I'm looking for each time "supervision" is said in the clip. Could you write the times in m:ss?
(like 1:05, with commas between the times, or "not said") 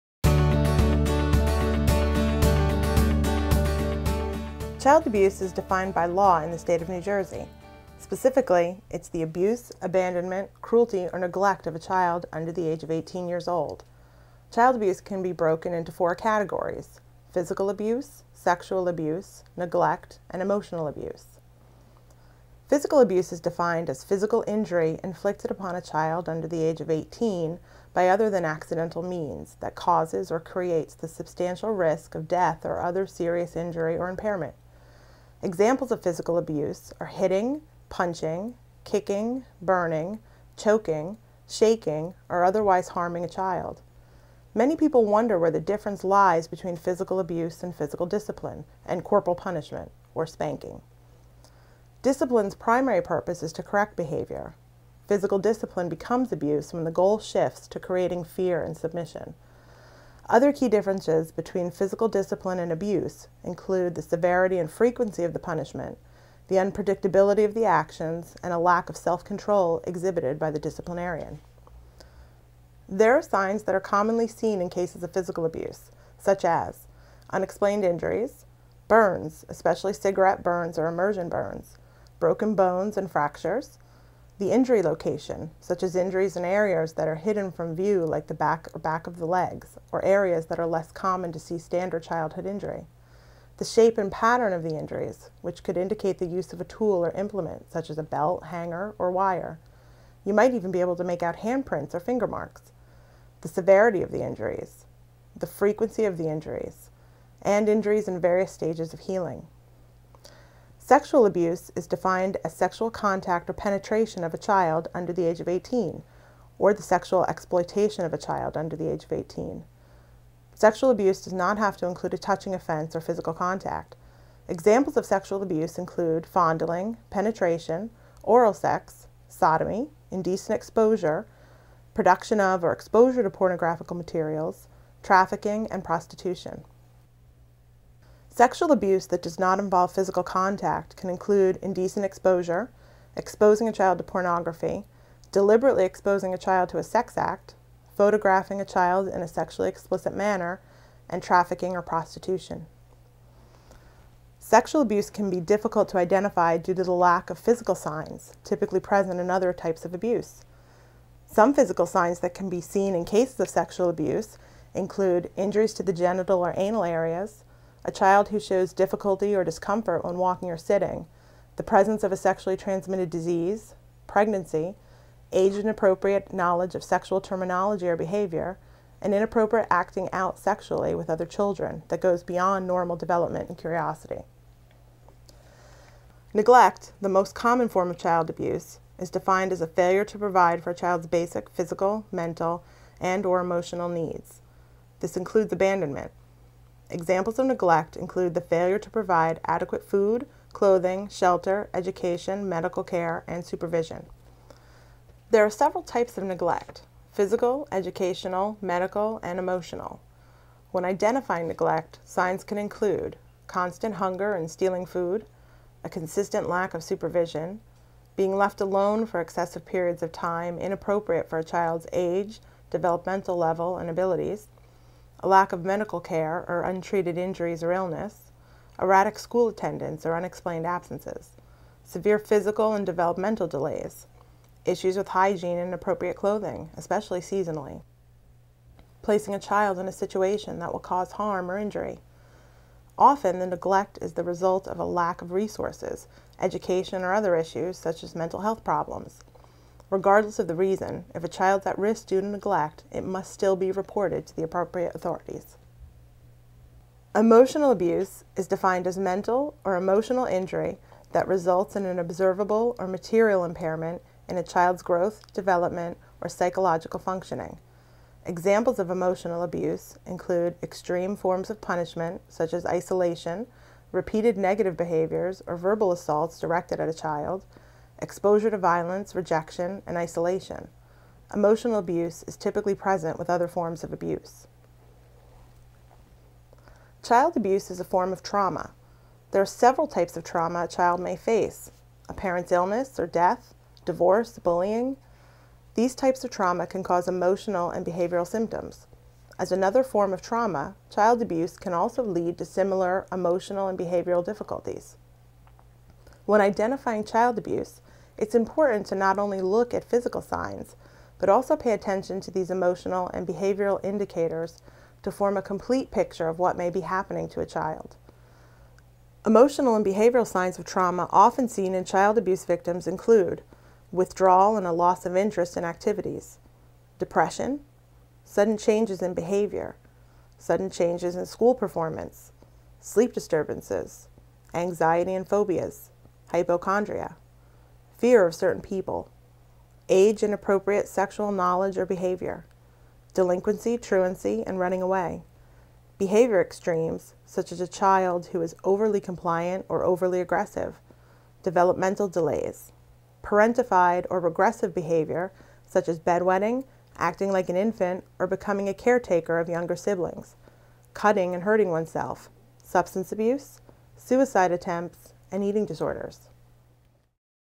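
3:23, 3:36.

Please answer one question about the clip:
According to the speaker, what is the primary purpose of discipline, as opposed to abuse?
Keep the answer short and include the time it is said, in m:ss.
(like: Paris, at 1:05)
To correct behavior, at 0:53.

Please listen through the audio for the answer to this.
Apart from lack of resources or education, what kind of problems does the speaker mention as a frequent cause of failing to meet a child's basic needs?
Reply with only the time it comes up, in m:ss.
4:08.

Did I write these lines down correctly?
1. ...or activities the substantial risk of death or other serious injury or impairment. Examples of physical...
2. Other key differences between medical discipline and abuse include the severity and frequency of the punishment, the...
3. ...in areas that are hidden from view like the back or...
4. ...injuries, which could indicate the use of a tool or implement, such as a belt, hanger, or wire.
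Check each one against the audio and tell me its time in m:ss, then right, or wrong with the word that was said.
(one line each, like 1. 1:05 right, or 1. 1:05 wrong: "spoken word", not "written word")
1. 0:30 wrong: "creates", not "activities"
2. 1:00 wrong: "physical", not "medical"
3. 1:26 right
4. 1:34 right.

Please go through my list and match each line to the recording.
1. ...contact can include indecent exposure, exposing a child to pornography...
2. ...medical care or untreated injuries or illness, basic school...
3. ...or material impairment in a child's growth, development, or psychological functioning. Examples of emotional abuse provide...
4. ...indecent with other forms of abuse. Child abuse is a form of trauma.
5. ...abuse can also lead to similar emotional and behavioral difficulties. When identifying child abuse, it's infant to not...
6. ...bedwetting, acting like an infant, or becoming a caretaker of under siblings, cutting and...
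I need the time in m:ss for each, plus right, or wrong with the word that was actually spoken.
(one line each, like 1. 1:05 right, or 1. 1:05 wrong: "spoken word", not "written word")
1. 2:20 right
2. 3:45 wrong: "erratic", not "basic"
3. 4:22 wrong: "include", not "provide"
4. 4:42 wrong: "present", not "indecent"
5. 5:01 wrong: "important", not "infant"
6. 5:55 wrong: "younger", not "under".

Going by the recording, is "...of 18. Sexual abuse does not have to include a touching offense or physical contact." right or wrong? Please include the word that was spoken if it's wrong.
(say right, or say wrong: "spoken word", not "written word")
right.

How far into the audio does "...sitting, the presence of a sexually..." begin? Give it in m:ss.
2:50.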